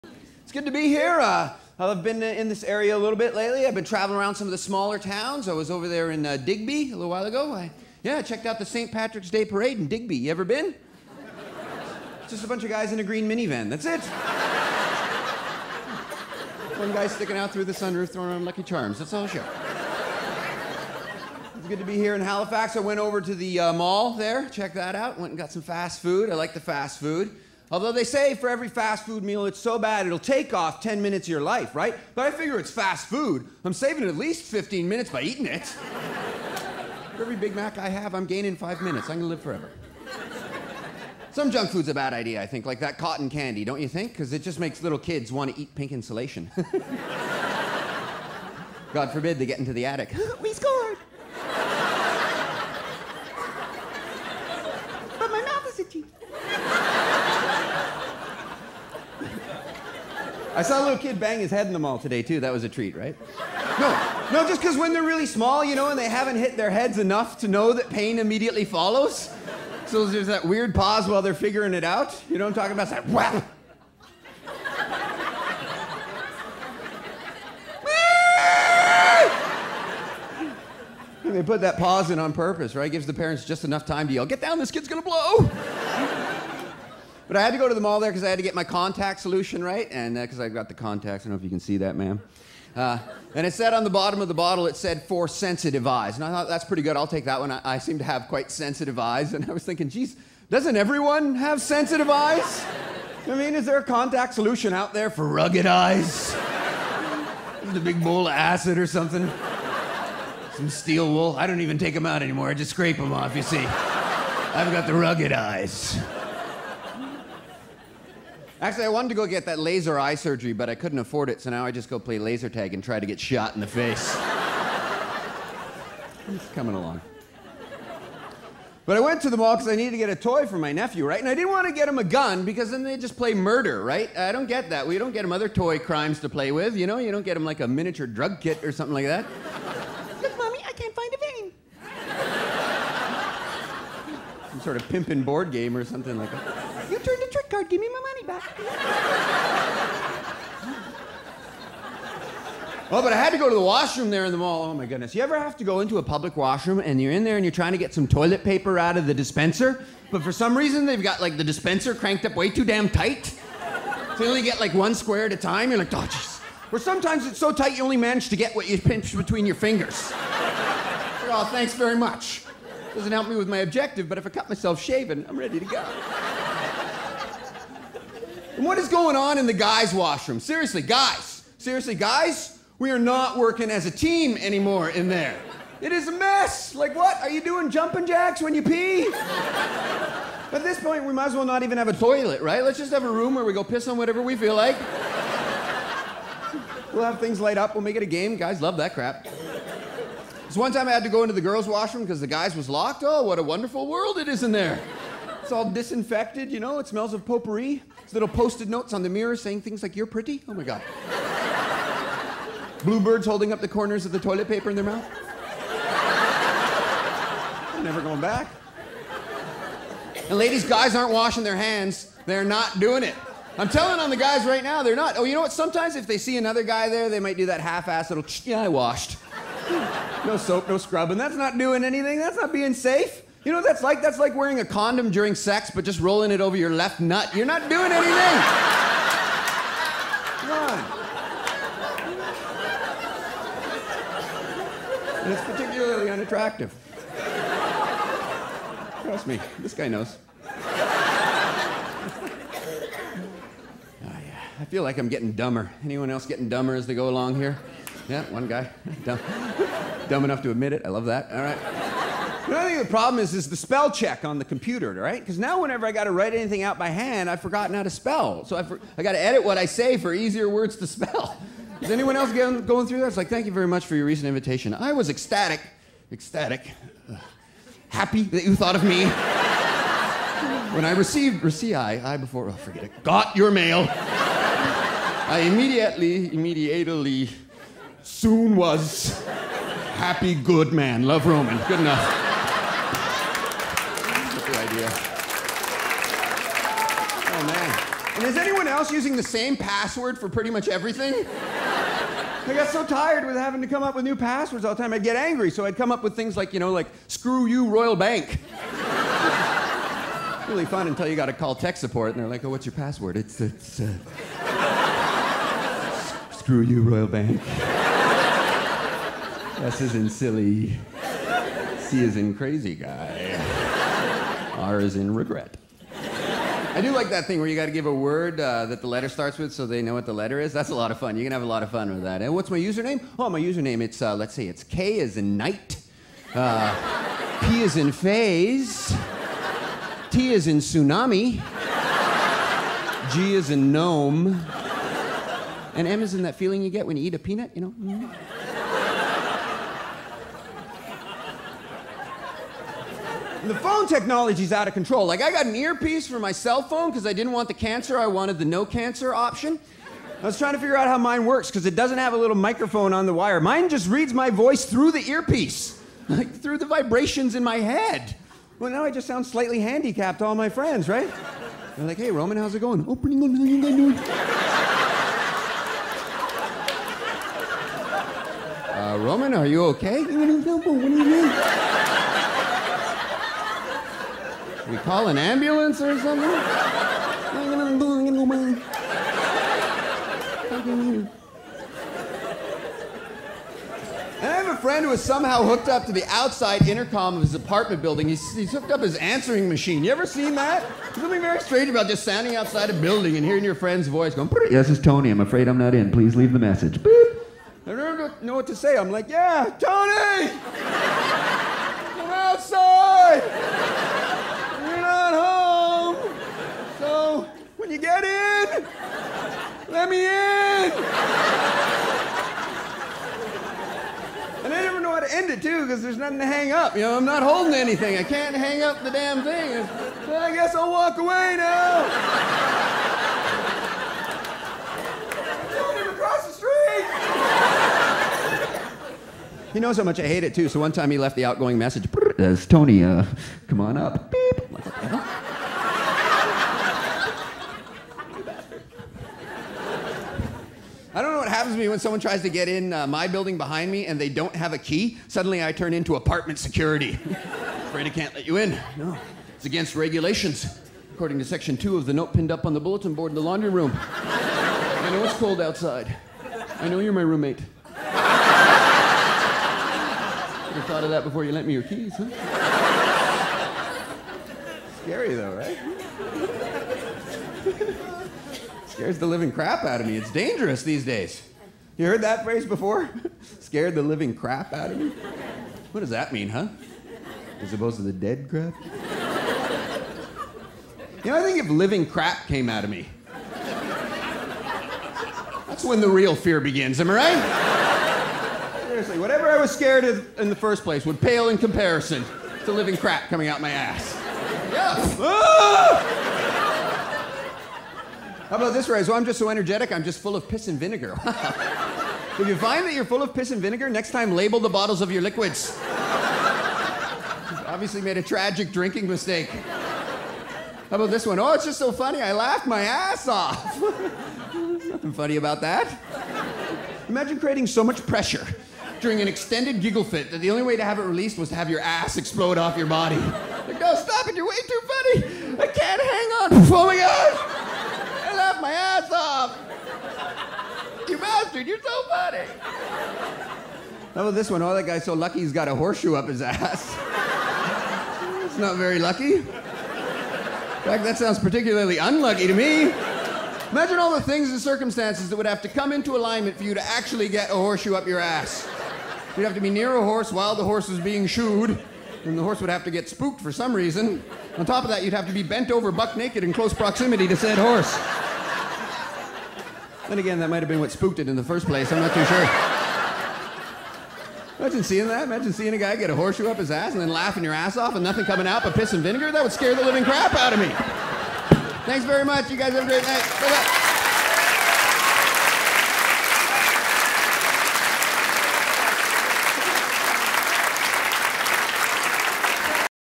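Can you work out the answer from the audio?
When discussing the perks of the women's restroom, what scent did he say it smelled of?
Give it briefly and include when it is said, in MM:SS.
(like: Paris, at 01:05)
potpourri, at 03:27.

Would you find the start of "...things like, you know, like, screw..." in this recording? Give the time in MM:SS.
05:06.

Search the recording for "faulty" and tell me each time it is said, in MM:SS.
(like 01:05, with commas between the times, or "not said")
not said.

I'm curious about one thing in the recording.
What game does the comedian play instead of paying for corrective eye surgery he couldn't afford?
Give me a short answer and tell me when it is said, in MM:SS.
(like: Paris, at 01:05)
laser tag, at 02:02.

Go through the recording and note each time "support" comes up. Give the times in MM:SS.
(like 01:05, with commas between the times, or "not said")
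05:11.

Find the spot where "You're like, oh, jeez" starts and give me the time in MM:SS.
02:45.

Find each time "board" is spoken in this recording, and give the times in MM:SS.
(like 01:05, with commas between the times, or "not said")
02:25, 07:42.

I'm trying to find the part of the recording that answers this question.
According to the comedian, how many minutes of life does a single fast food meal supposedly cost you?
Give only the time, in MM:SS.
00:30.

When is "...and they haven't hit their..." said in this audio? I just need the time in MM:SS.
01:05.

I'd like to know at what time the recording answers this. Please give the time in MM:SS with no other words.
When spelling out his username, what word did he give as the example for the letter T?
05:40.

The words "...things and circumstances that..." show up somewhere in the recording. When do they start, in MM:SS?
09:14.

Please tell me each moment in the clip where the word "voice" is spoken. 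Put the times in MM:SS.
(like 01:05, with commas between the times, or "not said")
06:04, 06:43.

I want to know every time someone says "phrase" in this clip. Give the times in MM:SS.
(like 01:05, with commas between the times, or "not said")
08:02, 08:28.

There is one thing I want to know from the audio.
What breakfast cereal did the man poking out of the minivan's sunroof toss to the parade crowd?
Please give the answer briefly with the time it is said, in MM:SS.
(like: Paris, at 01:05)
Lucky Charms, at 00:18.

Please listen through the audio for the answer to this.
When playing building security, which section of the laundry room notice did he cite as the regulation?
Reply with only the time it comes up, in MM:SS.
07:41.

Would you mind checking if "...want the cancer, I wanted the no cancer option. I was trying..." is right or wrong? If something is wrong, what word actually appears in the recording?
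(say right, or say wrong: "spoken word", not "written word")
right.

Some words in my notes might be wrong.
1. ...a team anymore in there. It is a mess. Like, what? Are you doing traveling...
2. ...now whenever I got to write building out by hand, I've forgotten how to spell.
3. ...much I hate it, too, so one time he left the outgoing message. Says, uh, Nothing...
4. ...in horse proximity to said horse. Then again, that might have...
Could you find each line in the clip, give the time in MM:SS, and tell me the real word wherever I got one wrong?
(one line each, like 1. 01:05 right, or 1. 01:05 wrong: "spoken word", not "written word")
1. 03:03 wrong: "jumping", not "traveling"
2. 04:25 wrong: "anything", not "building"
3. 07:19 wrong: "Tony", not "Nothing"
4. 09:26 wrong: "close", not "horse".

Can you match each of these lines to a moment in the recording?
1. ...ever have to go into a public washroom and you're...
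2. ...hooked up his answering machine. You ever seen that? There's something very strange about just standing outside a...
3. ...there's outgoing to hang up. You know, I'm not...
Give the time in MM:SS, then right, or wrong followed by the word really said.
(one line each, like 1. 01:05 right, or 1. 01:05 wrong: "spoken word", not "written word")
1. 02:35 right
2. 06:38 right
3. 07:05 wrong: "nothing", not "outgoing".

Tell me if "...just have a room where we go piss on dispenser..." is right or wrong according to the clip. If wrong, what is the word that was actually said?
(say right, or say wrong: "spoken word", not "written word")
wrong: "whatever", not "dispenser".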